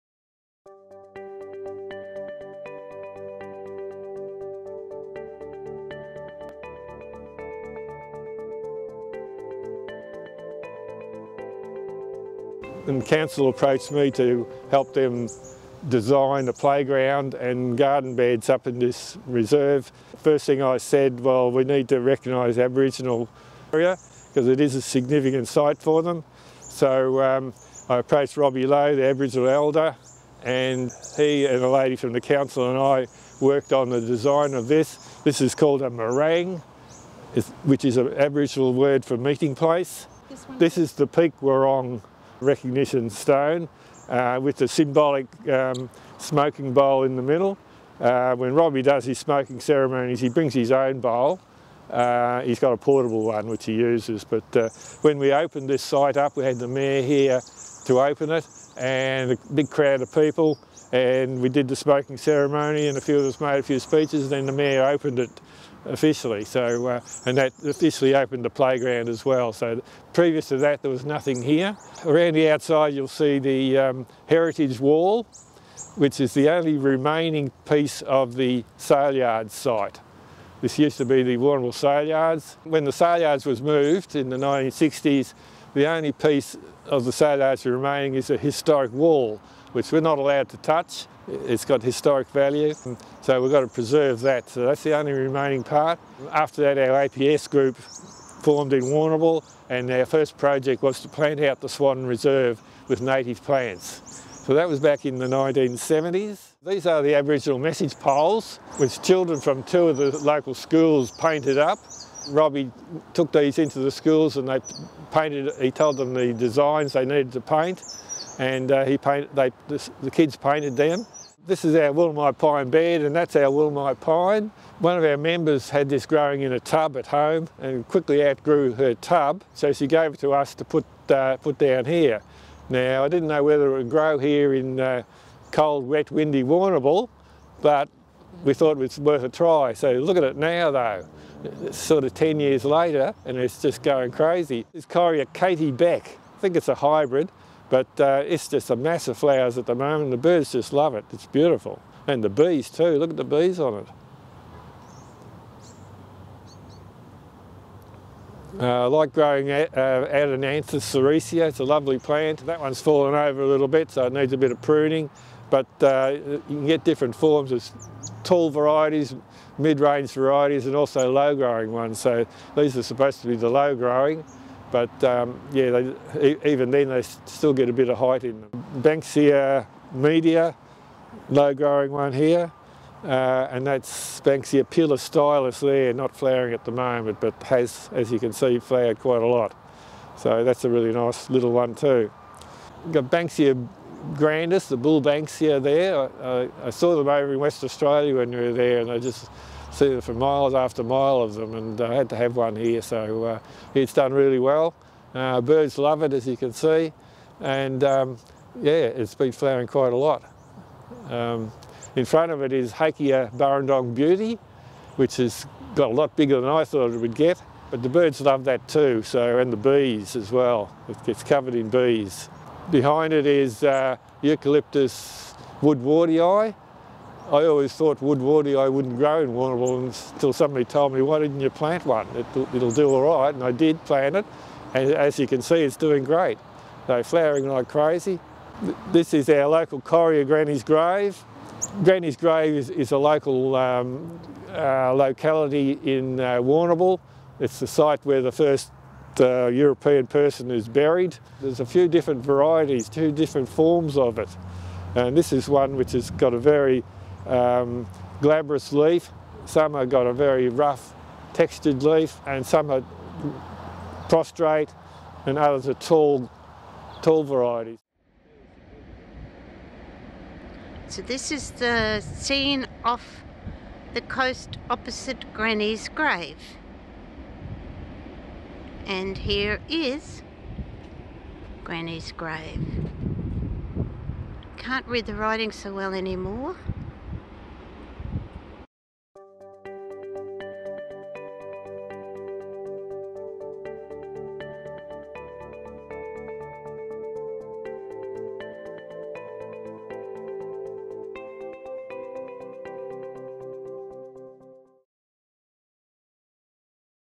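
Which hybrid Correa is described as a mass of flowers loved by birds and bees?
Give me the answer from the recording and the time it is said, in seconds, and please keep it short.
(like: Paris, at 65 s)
Correa Katie Beck, at 144 s.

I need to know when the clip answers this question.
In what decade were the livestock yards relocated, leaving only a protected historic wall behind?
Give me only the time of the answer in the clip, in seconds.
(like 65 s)
84 s.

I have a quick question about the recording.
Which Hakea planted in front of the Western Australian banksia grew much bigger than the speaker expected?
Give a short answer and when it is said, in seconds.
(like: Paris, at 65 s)
Hakea Burrendong Beauty, at 212 s.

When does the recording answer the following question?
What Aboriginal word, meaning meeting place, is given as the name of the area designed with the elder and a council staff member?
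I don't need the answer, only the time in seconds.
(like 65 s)
35 s.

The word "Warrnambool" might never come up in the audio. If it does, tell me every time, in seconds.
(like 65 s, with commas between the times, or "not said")
81 s, 98 s, 136 s, 229 s, 246 s.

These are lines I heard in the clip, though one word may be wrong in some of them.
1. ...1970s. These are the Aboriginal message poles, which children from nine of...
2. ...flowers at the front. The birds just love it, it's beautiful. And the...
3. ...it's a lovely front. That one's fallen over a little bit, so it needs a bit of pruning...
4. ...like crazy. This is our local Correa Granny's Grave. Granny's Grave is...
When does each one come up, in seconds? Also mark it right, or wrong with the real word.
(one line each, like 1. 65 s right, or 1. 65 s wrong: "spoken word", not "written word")
1. 105 s wrong: "two", not "nine"
2. 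149 s wrong: "moment", not "front"
3. 161 s wrong: "plant", not "front"
4. 237 s right.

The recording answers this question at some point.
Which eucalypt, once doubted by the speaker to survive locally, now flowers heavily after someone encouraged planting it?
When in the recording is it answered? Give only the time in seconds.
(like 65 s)
224 s.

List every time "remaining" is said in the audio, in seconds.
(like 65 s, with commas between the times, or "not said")
76 s, 87 s, 95 s.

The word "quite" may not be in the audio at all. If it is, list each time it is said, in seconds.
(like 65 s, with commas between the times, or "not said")
188 s, 209 s.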